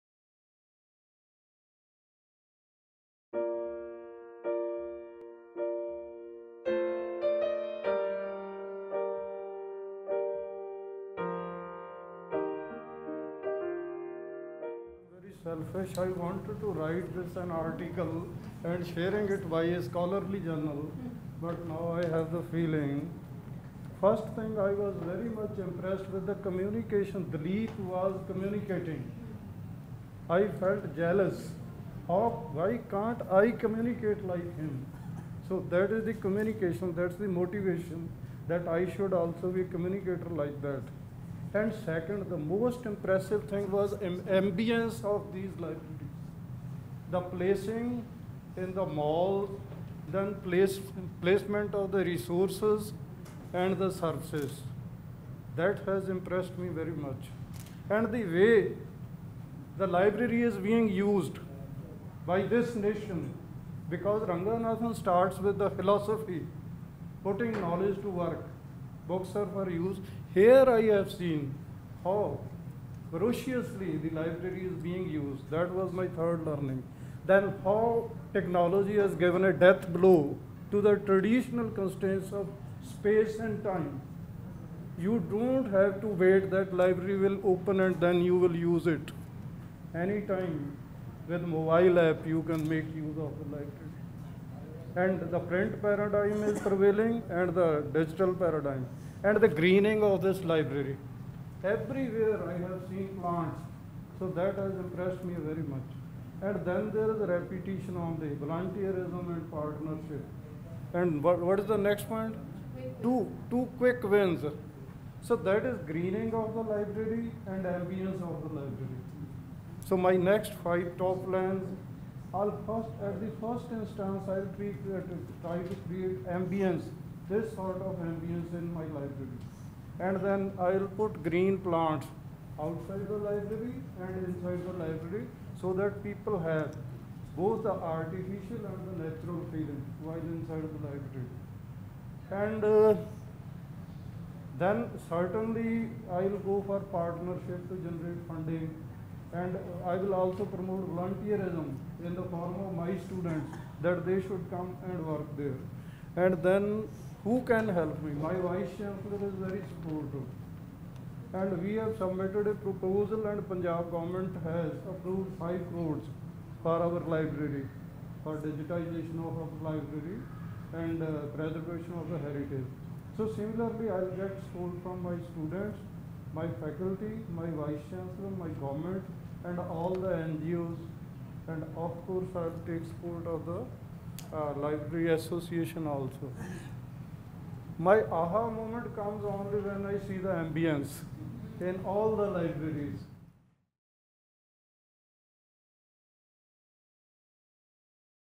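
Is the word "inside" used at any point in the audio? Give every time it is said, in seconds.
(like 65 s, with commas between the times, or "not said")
134 s, 140 s.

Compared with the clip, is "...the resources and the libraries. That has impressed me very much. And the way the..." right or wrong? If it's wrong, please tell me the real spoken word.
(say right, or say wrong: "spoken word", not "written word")
wrong: "services", not "libraries".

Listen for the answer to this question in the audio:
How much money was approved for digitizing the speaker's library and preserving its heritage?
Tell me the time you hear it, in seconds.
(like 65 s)
165 s.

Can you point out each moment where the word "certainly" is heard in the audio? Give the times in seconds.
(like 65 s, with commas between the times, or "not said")
145 s.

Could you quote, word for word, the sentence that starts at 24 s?
First thing, I was very much impressed with the communication Dalit was communicating.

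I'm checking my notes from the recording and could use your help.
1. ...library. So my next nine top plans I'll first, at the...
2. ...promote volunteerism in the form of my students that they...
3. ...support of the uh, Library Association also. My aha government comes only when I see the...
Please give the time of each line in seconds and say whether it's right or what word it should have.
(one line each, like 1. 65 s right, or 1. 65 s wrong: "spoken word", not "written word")
1. 118 s wrong: "five", not "nine"
2. 150 s right
3. 182 s wrong: "moment", not "government".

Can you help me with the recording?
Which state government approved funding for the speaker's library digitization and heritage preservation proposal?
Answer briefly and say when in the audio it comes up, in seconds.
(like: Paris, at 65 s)
Punjab, at 163 s.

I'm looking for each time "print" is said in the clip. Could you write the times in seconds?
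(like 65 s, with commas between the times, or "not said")
95 s.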